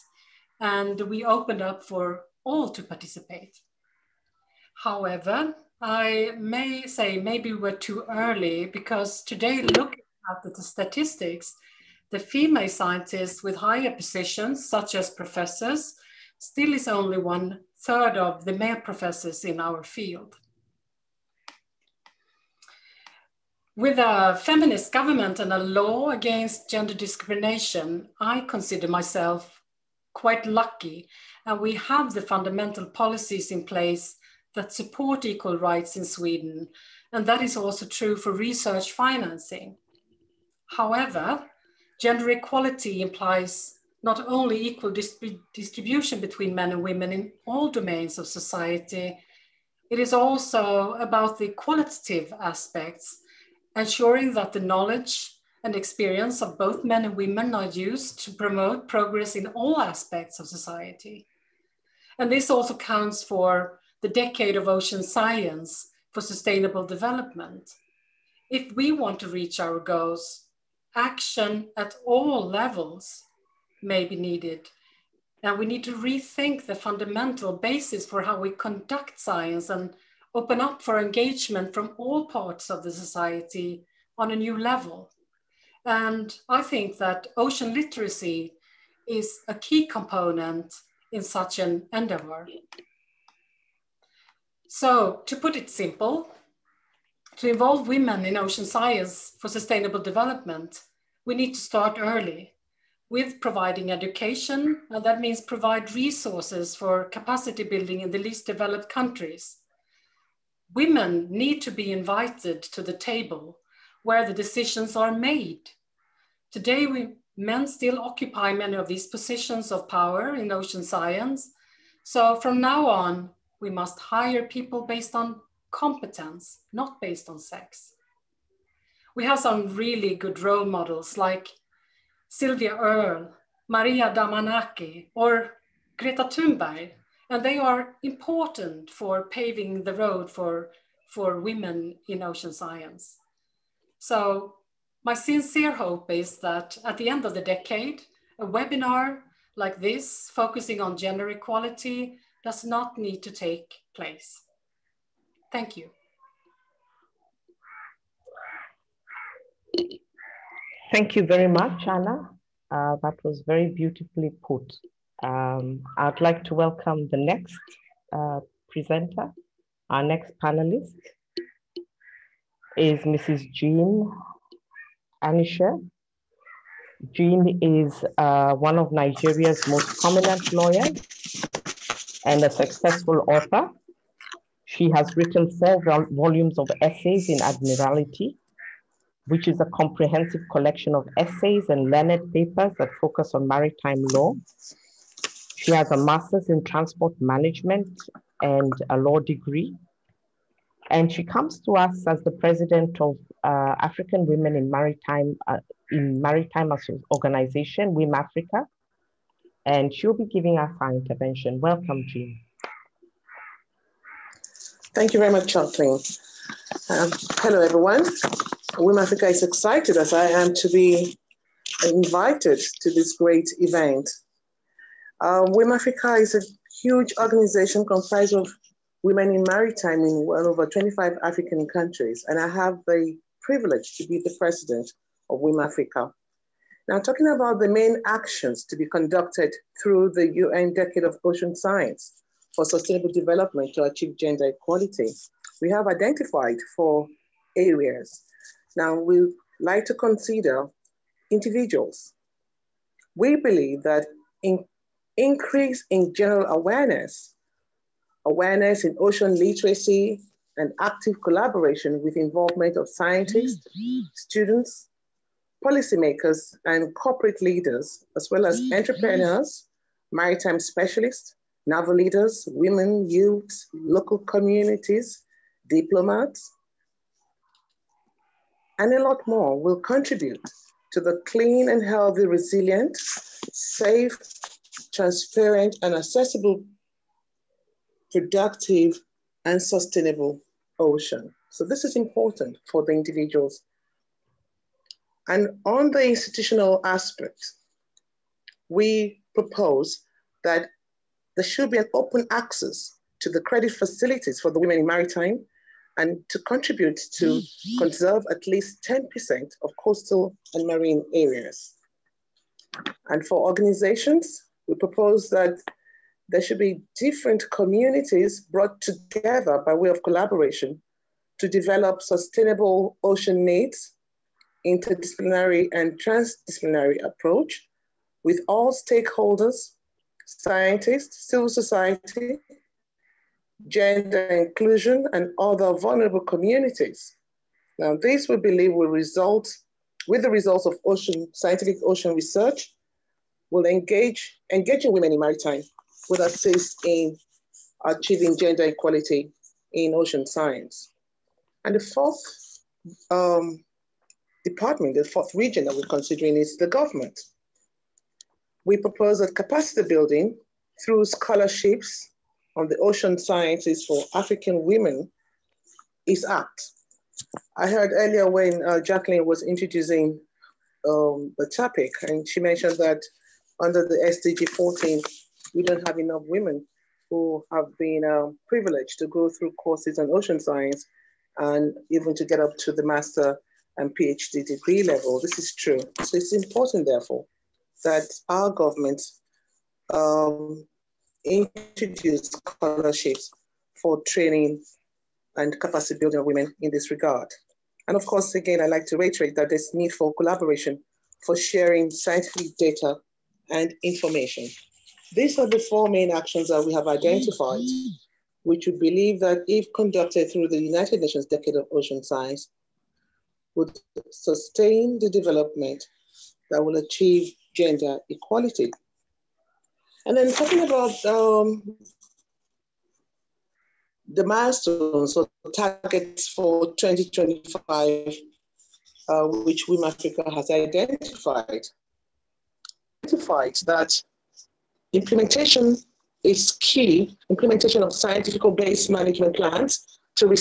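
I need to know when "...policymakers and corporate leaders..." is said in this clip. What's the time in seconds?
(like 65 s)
265 s.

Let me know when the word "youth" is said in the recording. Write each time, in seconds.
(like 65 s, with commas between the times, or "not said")
273 s.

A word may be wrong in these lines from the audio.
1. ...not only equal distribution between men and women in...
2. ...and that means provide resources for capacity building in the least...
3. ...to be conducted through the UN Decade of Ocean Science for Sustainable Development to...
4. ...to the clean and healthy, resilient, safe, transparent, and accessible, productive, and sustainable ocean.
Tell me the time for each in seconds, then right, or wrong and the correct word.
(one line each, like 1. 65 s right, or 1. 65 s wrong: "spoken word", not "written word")
1. 44 s right
2. 104 s right
3. 238 s right
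4. 280 s right.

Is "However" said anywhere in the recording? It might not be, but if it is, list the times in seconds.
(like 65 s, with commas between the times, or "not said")
4 s, 40 s.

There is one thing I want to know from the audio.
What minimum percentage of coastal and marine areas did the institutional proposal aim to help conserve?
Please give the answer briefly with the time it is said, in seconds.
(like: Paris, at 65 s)
10%, at 308 s.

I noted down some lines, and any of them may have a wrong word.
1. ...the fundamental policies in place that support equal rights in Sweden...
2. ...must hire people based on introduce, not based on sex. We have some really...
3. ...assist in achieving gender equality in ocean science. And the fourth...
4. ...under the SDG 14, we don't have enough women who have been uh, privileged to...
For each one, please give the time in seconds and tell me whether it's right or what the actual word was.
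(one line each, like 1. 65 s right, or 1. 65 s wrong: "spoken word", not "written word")
1. 32 s right
2. 123 s wrong: "competence", not "introduce"
3. 346 s right
4. 373 s right.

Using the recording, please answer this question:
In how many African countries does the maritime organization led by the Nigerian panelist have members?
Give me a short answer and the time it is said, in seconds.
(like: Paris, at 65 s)
over 25, at 230 s.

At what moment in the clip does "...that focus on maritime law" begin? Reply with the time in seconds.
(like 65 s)
192 s.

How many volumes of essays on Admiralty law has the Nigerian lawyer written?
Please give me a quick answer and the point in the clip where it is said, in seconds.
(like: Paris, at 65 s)
4, at 185 s.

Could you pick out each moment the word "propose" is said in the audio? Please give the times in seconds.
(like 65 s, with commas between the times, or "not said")
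299 s, 314 s, 358 s.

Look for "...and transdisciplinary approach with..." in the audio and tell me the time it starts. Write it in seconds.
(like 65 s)
325 s.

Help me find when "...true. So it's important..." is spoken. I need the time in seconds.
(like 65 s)
385 s.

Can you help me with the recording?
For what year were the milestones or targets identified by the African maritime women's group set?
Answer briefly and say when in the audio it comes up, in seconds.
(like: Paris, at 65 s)
2025, at 426 s.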